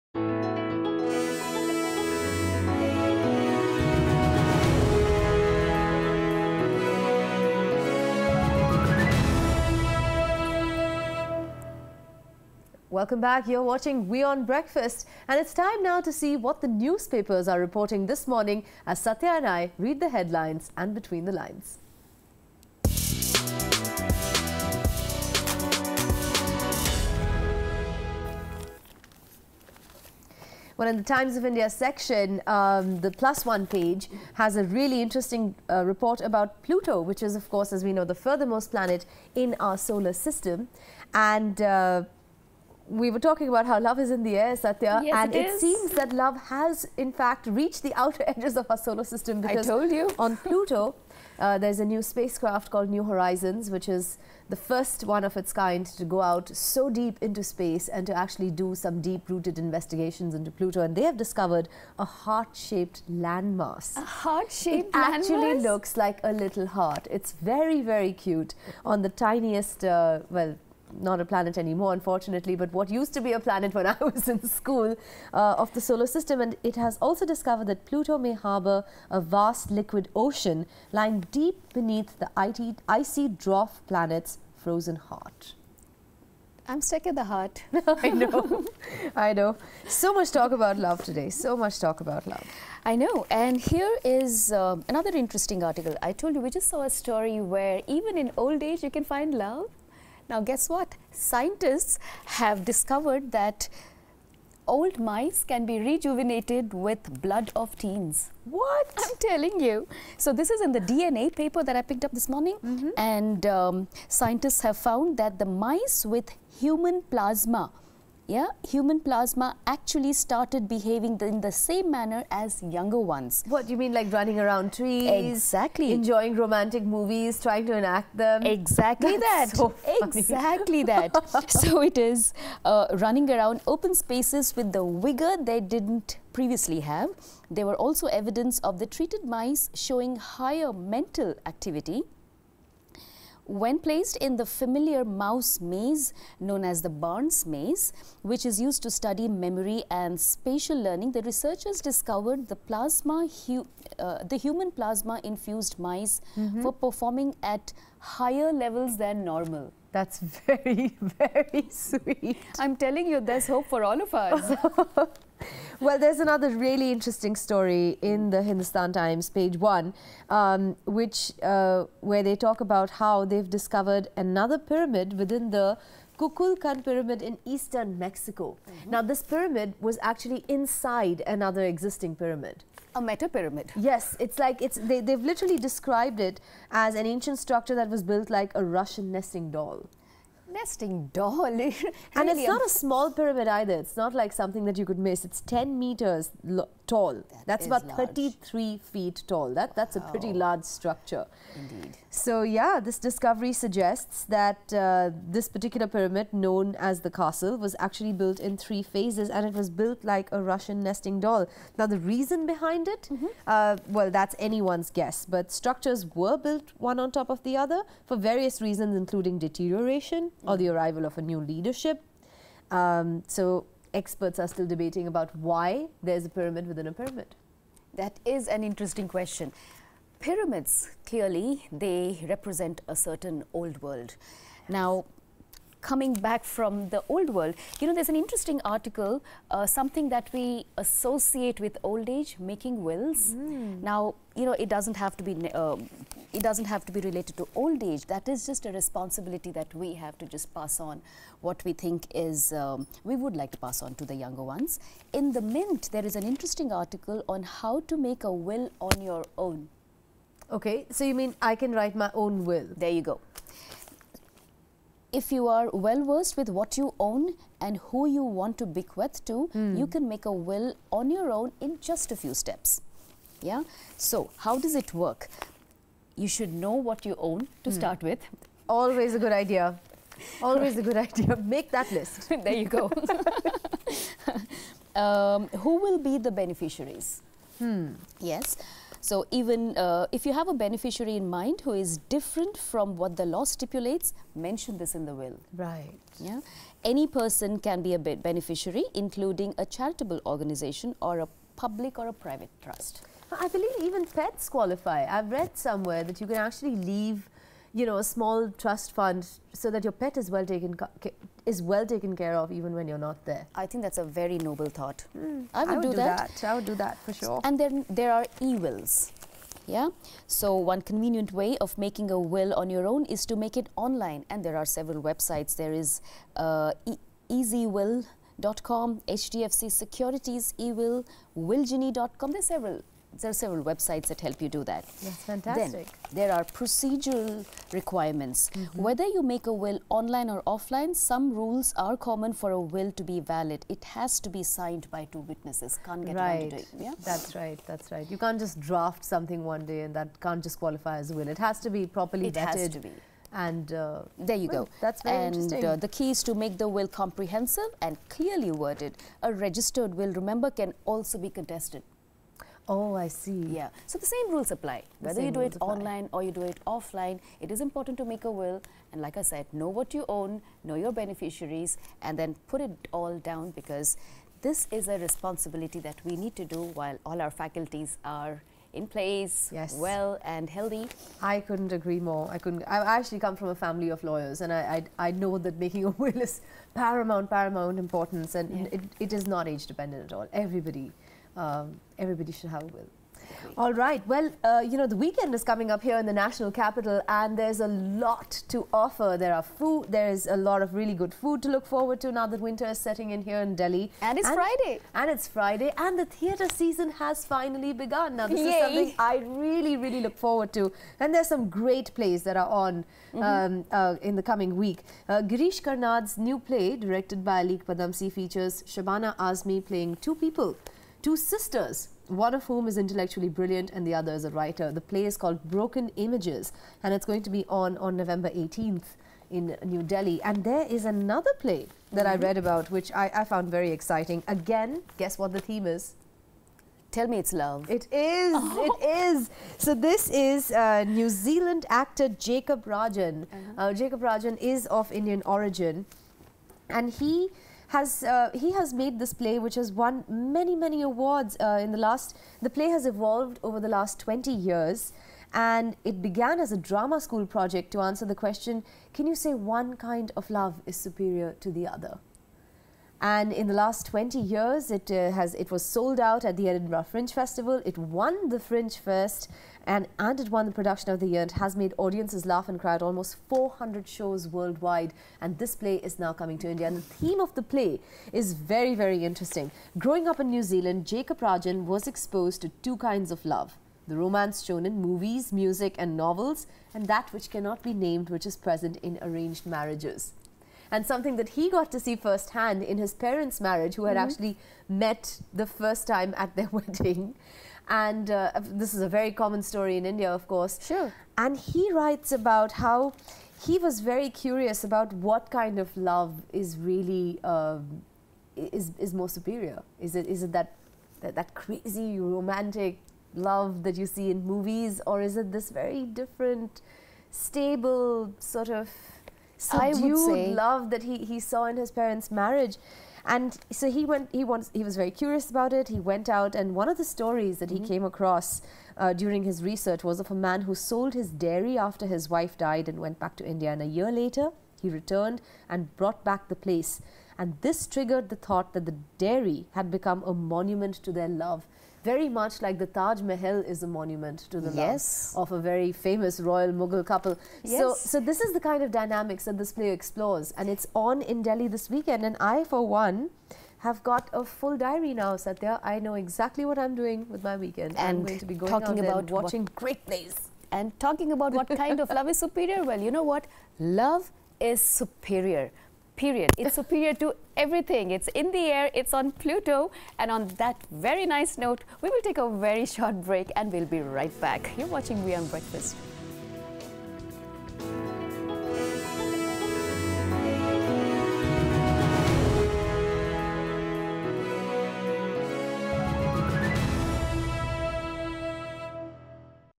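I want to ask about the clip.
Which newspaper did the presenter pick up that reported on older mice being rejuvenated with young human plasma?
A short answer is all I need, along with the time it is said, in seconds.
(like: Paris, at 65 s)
DNA, at 110 s.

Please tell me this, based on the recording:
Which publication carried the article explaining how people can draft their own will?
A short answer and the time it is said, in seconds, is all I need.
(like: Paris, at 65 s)
The Mint, at 255 s.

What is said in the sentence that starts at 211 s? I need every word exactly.
Now the reason behind it, mm -hmm.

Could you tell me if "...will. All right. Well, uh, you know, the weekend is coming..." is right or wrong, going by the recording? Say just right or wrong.
right.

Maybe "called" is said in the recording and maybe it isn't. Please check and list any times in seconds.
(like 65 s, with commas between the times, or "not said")
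52 s, 425 s.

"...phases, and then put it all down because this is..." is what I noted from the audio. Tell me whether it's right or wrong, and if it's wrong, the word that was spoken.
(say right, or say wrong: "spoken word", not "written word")
wrong: "beneficiaries", not "phases".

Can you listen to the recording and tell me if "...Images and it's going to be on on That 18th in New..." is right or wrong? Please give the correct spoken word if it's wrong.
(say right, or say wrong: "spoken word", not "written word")
wrong: "November", not "That".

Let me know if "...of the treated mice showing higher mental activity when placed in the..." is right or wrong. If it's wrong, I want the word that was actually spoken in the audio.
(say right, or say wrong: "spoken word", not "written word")
right.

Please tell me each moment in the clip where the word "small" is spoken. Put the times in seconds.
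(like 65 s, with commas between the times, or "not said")
192 s, 308 s.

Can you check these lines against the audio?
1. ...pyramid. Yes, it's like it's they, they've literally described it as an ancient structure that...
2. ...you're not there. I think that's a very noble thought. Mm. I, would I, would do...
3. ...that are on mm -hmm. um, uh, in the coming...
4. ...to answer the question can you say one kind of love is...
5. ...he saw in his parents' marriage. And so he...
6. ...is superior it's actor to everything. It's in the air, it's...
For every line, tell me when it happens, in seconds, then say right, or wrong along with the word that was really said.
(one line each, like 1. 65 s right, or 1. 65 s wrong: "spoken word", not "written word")
1. 183 s right
2. 312 s right
3. 412 s right
4. 457 s right
5. 520 s right
6. 564 s wrong: "superior", not "actor".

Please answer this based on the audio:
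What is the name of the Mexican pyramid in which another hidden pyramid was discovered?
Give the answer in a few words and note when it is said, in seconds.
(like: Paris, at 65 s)
Kukulkan, at 176 s.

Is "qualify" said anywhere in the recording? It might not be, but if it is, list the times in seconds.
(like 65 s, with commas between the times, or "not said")
304 s, 350 s.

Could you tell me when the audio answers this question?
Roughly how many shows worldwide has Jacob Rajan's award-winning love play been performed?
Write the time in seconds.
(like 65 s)
473 s.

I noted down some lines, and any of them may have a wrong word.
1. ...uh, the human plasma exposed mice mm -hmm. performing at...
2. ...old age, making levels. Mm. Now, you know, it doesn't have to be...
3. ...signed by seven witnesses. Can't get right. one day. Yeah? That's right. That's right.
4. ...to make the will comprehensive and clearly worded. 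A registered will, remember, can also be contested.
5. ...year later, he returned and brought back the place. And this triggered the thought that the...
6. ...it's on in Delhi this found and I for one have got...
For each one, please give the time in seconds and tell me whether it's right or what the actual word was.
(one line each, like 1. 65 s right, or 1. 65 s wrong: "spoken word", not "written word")
1. 153 s wrong: "infused", not "exposed"
2. 241 s wrong: "wills", not "levels"
3. 344 s wrong: "two", not "seven"
4. 356 s right
5. 533 s right
6. 550 s wrong: "weekend", not "found".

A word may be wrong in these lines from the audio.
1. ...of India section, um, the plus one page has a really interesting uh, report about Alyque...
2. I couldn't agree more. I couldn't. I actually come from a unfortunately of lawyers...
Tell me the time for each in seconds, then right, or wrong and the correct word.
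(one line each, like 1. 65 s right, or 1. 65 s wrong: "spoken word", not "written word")
1. 31 s wrong: "Pluto", not "Alyque"
2. 381 s wrong: "family", not "unfortunately".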